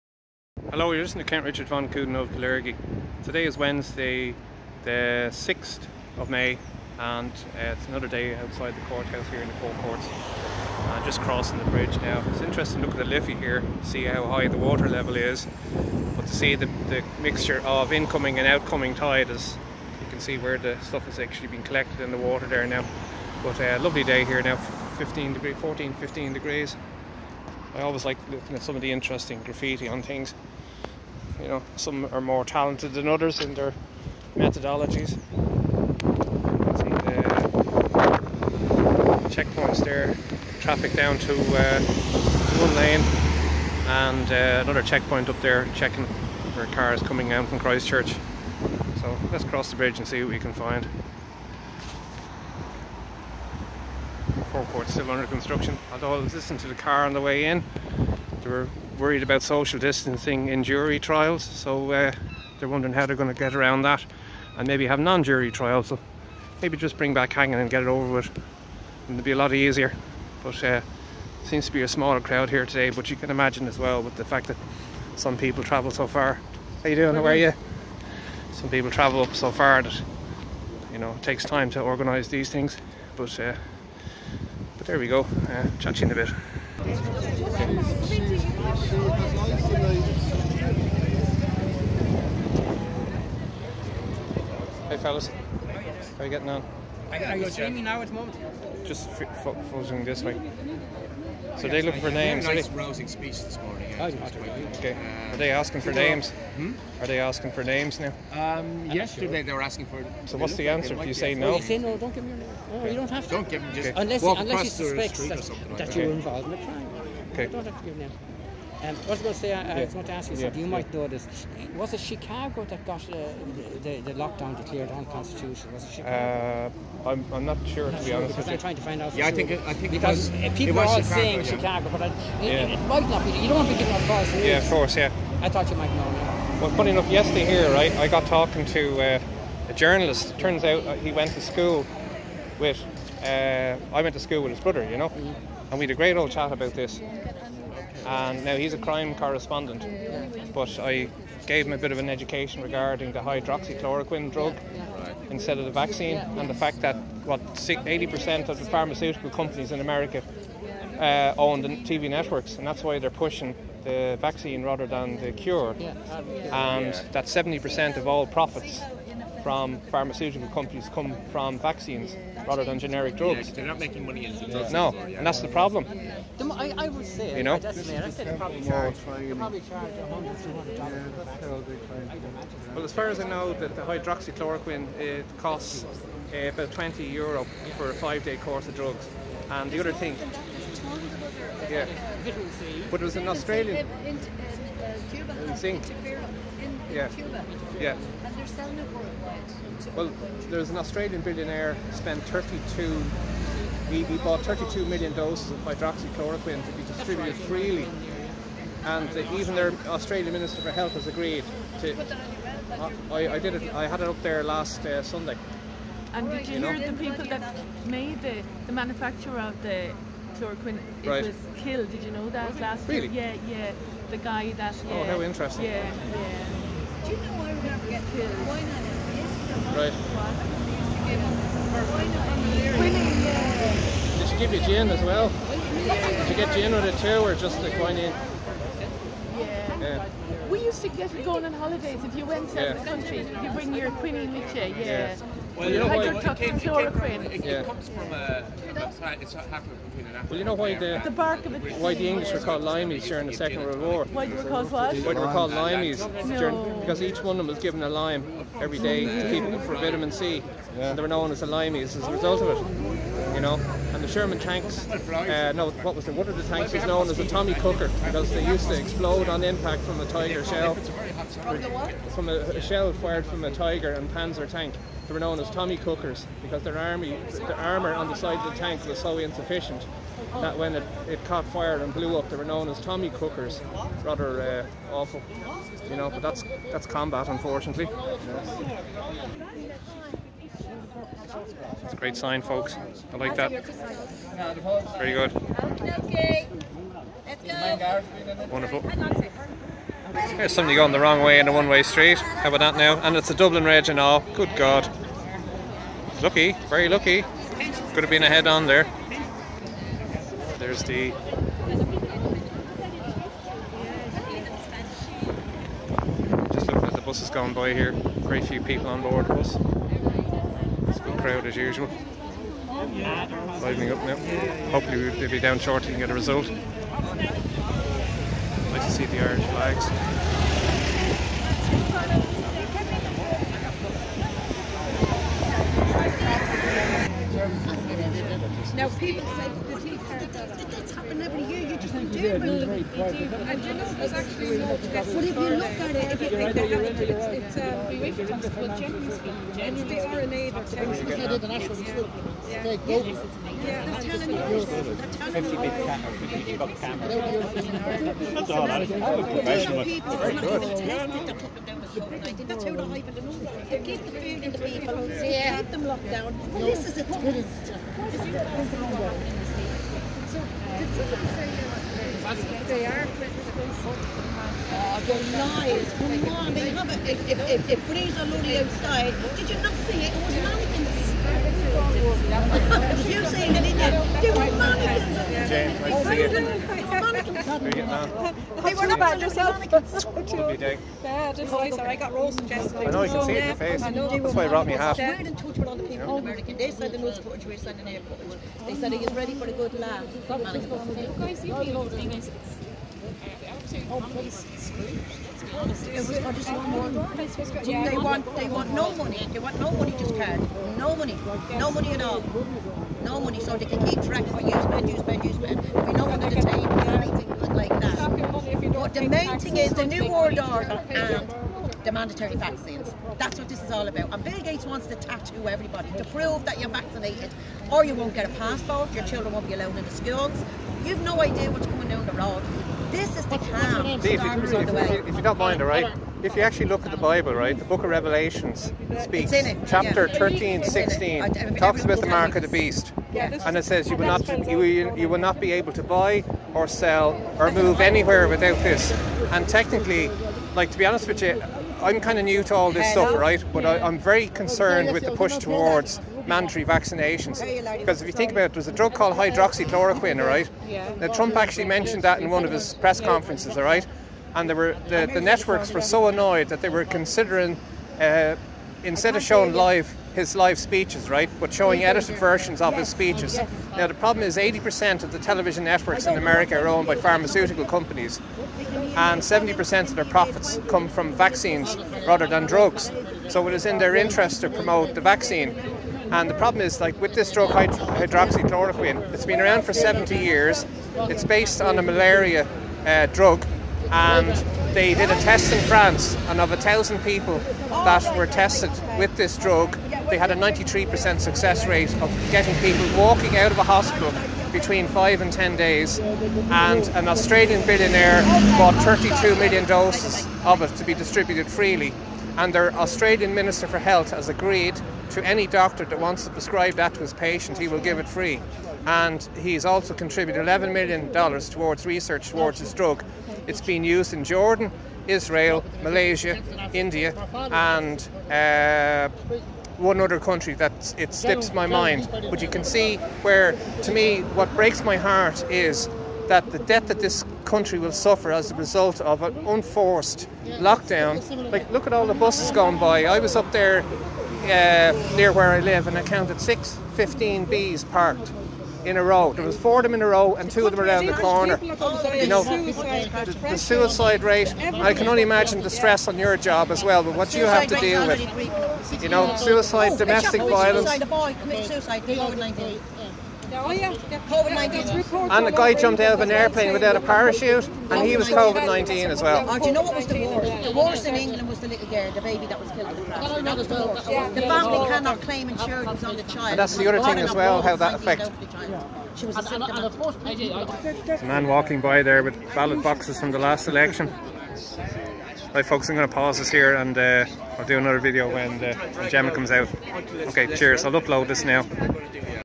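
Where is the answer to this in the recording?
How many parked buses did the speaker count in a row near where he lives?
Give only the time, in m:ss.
9:06.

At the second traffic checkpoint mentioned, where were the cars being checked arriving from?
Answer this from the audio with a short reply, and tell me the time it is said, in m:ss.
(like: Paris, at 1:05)
Christchurch, at 0:47.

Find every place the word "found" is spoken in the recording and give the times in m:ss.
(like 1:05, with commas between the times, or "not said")
not said.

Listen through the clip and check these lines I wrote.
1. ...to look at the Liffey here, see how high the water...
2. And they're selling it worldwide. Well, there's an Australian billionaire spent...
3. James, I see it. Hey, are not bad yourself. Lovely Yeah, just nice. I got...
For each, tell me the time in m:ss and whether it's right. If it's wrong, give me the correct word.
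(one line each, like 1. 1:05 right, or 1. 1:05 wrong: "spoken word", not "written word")
1. 0:12 right
2. 3:18 right
3. 6:25 right.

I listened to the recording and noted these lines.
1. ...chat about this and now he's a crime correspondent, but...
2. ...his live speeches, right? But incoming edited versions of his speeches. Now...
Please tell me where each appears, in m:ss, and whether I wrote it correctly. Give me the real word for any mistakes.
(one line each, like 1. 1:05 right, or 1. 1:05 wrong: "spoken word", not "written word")
1. 2:26 right
2. 7:50 wrong: "showing", not "incoming".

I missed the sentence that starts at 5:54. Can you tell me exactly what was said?
50 big camera, 50 That's all that is.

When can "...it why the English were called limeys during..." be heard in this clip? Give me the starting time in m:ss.
4:11.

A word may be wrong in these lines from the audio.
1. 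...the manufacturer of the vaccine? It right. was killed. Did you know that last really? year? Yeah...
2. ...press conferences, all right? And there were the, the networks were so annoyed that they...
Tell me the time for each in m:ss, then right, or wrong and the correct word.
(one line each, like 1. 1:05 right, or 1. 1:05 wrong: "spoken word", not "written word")
1. 3:38 wrong: "chloroquine", not "vaccine"
2. 7:42 right.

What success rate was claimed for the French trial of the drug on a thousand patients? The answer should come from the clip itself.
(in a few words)
93%.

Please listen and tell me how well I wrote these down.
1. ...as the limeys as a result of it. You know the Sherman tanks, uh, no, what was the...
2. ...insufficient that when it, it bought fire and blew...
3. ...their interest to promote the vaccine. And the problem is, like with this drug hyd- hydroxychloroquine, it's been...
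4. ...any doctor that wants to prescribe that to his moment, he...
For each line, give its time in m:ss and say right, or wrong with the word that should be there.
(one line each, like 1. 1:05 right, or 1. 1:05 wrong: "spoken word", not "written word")
1. 4:21 right
2. 4:39 wrong: "caught", not "bought"
3. 8:03 right
4. 8:35 wrong: "patient", not "moment".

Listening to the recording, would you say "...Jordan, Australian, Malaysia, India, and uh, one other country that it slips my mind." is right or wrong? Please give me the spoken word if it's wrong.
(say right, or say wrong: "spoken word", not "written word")
wrong: "Israel", not "Australian".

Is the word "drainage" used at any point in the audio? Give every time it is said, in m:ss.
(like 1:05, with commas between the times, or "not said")
not said.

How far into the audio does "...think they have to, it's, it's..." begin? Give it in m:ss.
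5:46.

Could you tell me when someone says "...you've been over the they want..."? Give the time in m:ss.
6:41.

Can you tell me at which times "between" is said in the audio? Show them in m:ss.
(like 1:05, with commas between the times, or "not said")
4:09, 8:24.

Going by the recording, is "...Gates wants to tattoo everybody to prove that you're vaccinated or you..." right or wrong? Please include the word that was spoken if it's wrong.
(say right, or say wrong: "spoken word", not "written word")
right.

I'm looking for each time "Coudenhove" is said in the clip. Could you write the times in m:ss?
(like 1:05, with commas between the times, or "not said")
0:01.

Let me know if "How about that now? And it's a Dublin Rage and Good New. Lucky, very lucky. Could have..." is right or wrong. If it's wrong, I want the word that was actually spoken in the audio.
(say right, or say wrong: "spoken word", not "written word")
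wrong: "God", not "New".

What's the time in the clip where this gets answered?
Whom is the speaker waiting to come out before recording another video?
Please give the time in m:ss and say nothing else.
9:49.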